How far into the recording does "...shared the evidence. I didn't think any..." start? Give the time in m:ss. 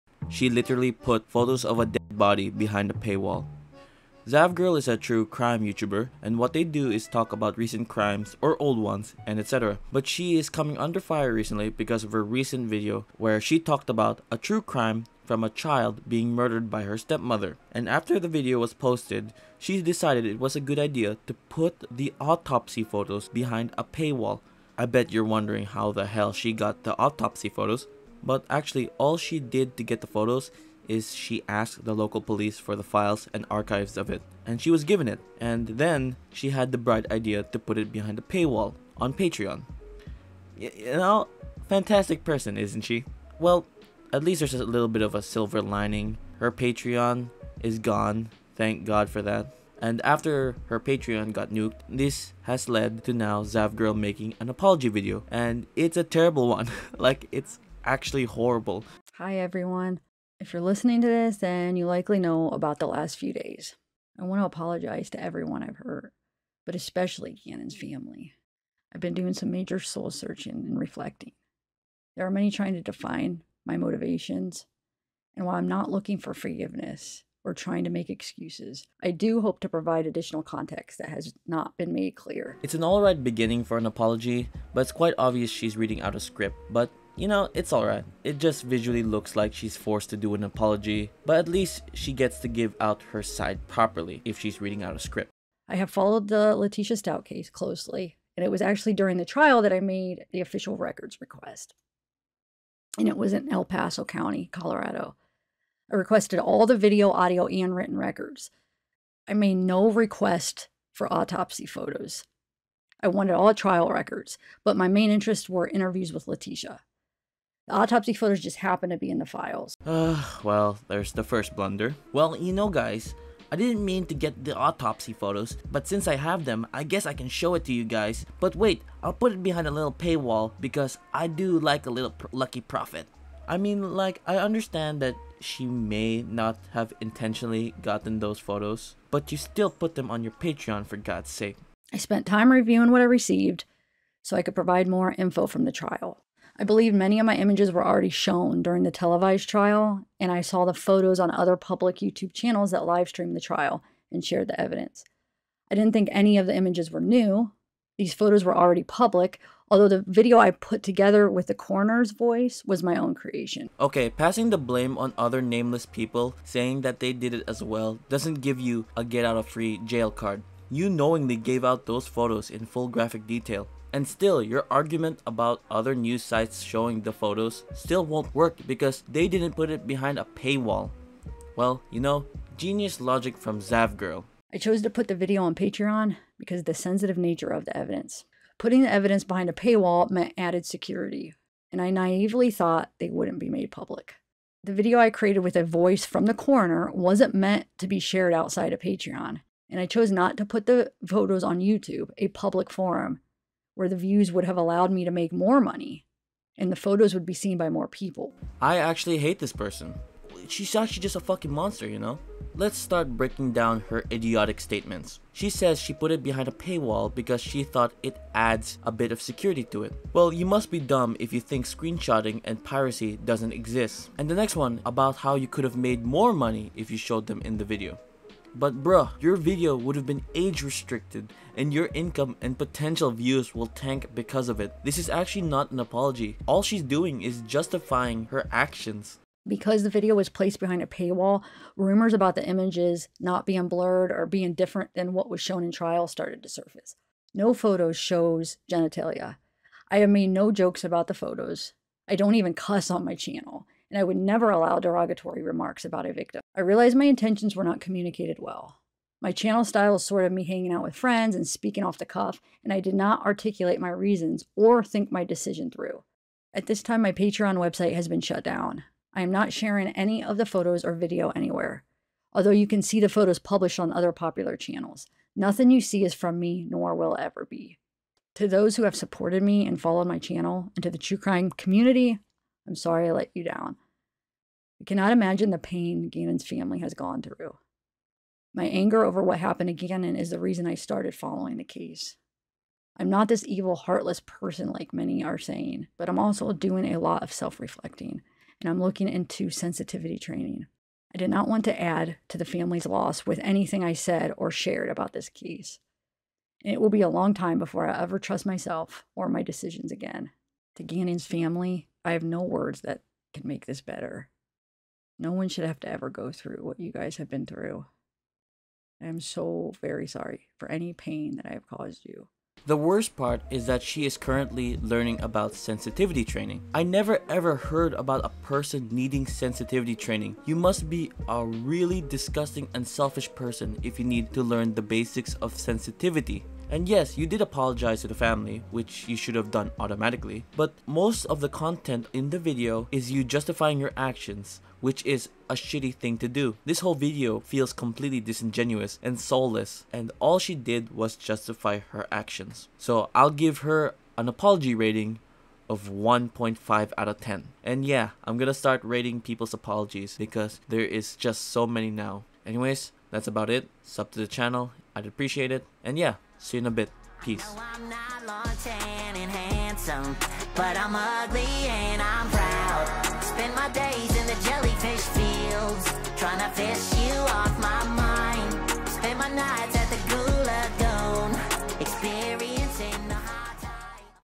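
2:34.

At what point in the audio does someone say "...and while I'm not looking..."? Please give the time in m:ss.
1:15.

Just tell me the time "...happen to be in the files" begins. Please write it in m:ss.
1:58.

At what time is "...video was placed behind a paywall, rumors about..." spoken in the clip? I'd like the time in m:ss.
3:59.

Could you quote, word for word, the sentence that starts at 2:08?
But wait, I'll put it behind a little paywall because I do like a little pr lucky profit.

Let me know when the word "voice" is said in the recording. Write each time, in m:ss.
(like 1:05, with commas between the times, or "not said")
2:42, 3:15.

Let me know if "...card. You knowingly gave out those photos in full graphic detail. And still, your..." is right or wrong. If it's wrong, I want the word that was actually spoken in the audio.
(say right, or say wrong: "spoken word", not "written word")
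right.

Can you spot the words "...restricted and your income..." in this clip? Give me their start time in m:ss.
3:50.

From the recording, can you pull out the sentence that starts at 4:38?
To those who have supported me and followed my channel, and to the true crime community, I'm sorry I let you down.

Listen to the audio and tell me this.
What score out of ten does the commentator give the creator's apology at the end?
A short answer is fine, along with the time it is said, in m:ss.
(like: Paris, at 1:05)
1.5, at 5:55.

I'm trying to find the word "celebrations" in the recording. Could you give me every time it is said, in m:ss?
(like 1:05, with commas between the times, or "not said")
not said.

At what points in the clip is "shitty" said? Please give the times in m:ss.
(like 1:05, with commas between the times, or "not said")
5:45.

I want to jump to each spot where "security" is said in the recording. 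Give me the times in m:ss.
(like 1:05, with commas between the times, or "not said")
3:10, 3:39.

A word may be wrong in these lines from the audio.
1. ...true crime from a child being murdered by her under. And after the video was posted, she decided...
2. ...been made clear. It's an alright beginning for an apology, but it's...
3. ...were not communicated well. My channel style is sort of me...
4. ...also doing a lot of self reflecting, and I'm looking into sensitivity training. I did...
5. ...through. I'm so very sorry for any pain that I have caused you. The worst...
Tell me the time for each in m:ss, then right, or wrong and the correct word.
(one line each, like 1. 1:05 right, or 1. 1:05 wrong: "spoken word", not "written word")
1. 0:14 wrong: "stepmother", not "under"
2. 1:21 right
3. 4:17 right
4. 4:56 right
5. 5:17 right.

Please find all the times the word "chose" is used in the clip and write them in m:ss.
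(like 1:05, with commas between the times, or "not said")
3:04, 3:19.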